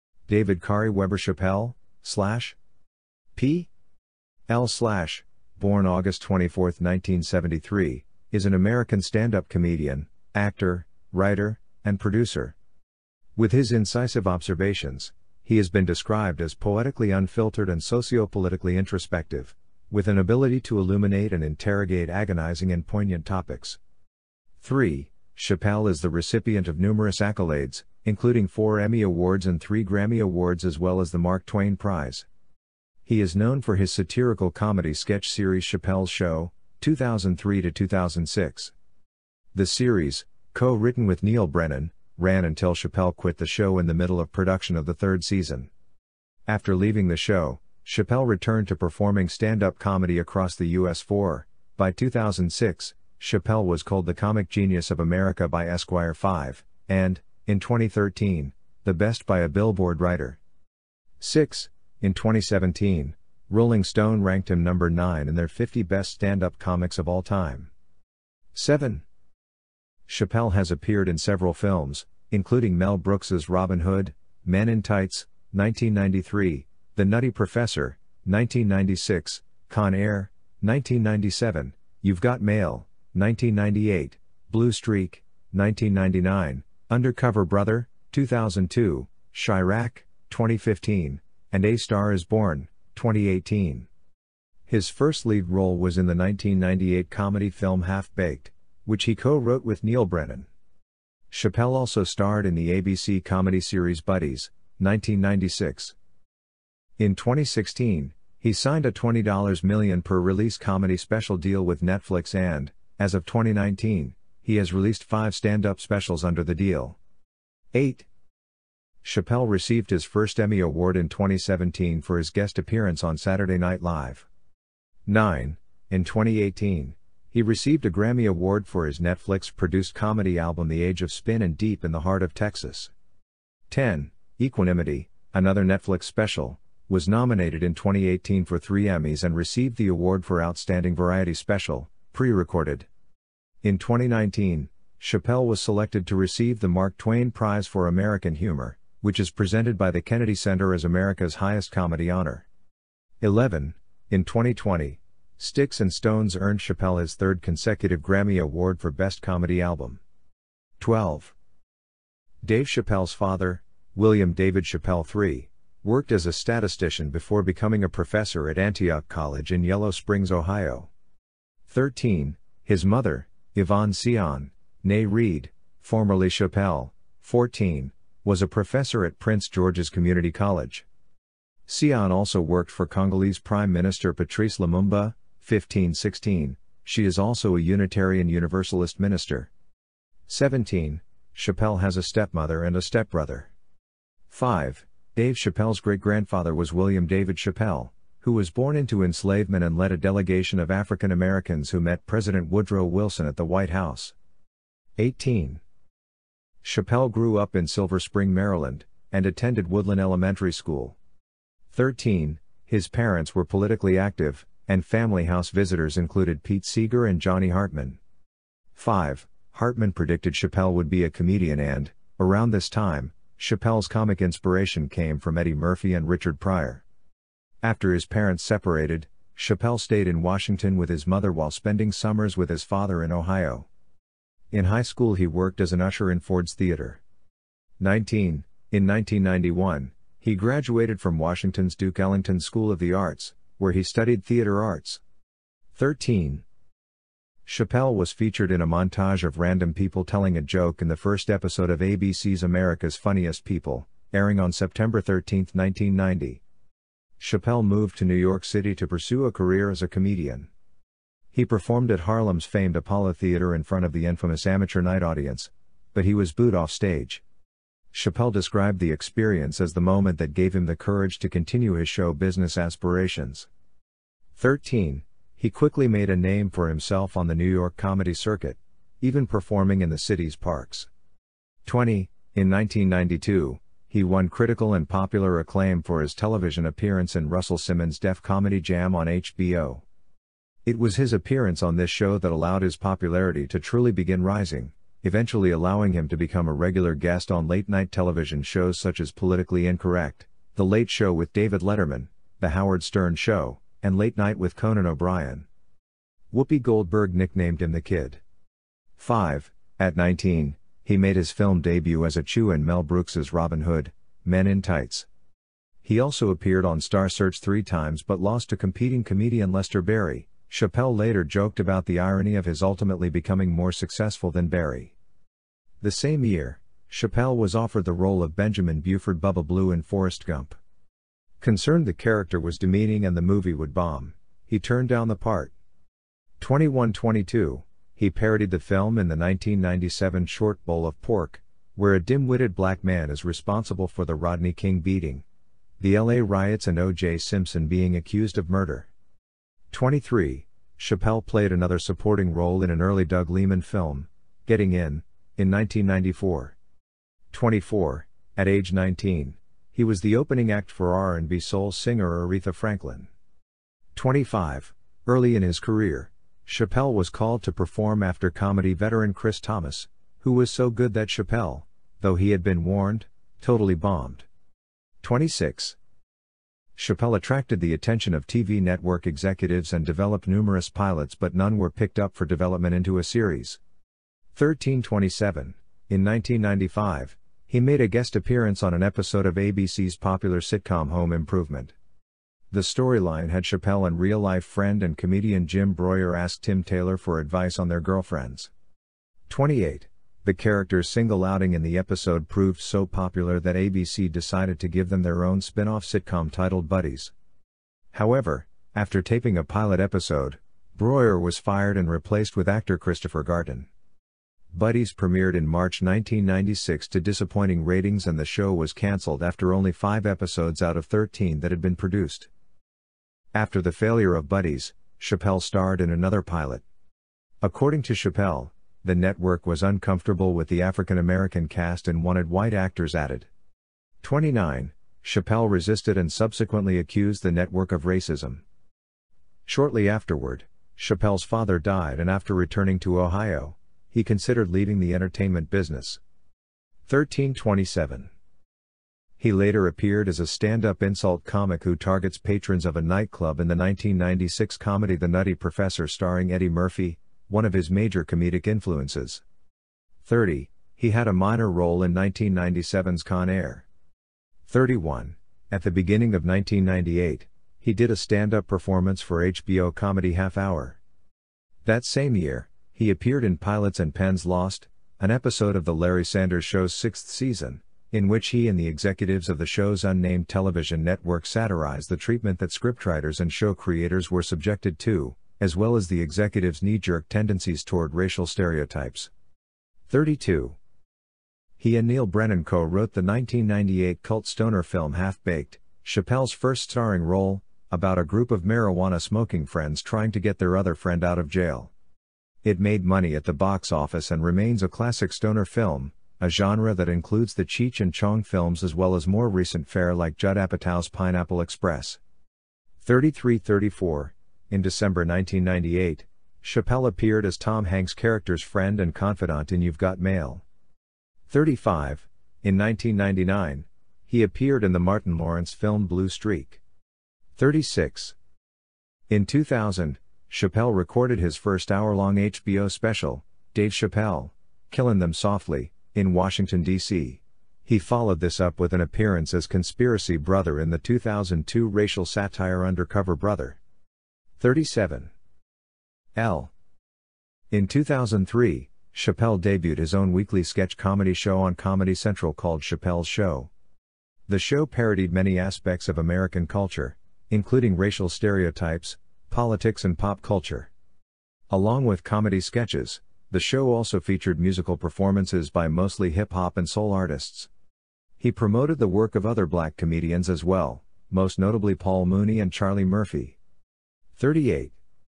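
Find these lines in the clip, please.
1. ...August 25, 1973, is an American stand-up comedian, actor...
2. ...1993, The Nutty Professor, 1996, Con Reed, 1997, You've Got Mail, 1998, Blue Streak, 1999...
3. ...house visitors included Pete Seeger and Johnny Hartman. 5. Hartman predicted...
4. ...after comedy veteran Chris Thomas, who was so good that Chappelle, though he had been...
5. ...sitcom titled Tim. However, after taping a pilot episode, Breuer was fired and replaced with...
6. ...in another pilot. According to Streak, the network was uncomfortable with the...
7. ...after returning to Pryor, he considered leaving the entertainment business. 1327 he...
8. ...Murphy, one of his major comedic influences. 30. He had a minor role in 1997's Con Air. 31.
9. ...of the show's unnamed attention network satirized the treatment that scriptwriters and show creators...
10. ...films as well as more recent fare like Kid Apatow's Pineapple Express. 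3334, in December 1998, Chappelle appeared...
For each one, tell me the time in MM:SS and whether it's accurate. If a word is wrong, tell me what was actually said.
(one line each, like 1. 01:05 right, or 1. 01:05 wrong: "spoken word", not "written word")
1. 00:05 wrong: "24", not "25"
2. 01:15 wrong: "Air", not "Reed"
3. 03:35 right
4. 06:08 right
5. 06:45 wrong: "Buddies", not "Tim"
6. 07:05 wrong: "Chappelle", not "Streak"
7. 07:22 wrong: "Ohio", not "Pryor"
8. 07:36 right
9. 07:59 wrong: "television", not "attention"
10. 08:28 wrong: "Judd", not "Kid".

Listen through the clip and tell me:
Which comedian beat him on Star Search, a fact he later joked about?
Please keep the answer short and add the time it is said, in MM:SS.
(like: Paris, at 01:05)
Lester Barrie, at 05:19.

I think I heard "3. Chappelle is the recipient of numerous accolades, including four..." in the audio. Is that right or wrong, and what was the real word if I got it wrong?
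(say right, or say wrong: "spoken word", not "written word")
right.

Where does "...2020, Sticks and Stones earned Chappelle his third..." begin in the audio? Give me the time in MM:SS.
02:34.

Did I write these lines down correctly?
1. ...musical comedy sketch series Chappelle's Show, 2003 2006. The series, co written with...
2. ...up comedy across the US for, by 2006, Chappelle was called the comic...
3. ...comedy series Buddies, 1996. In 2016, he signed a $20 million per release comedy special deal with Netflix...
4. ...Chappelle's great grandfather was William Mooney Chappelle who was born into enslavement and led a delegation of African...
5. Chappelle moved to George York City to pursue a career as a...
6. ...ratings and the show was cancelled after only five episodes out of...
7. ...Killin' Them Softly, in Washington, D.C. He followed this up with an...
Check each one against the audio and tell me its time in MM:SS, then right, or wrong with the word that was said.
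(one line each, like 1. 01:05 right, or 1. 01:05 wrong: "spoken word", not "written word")
1. 00:33 wrong: "satirical", not "musical"
2. 00:49 right
3. 01:43 right
4. 03:15 wrong: "David", not "Mooney"
5. 04:17 wrong: "New", not "George"
6. 06:57 right
7. 08:54 right.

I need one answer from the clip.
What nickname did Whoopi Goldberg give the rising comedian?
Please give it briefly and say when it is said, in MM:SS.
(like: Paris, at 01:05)
the Kid, at 05:07.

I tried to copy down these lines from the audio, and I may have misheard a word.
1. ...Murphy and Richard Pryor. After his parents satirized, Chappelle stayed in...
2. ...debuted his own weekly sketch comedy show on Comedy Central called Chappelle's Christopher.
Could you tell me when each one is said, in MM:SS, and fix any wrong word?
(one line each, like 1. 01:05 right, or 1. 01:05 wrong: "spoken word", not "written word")
1. 03:45 wrong: "separated", not "satirized"
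2. 09:09 wrong: "Show", not "Christopher".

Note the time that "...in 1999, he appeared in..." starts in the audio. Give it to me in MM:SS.
08:42.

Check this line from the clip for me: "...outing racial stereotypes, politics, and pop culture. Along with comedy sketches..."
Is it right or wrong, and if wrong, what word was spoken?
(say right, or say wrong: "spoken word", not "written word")
wrong: "including", not "outing".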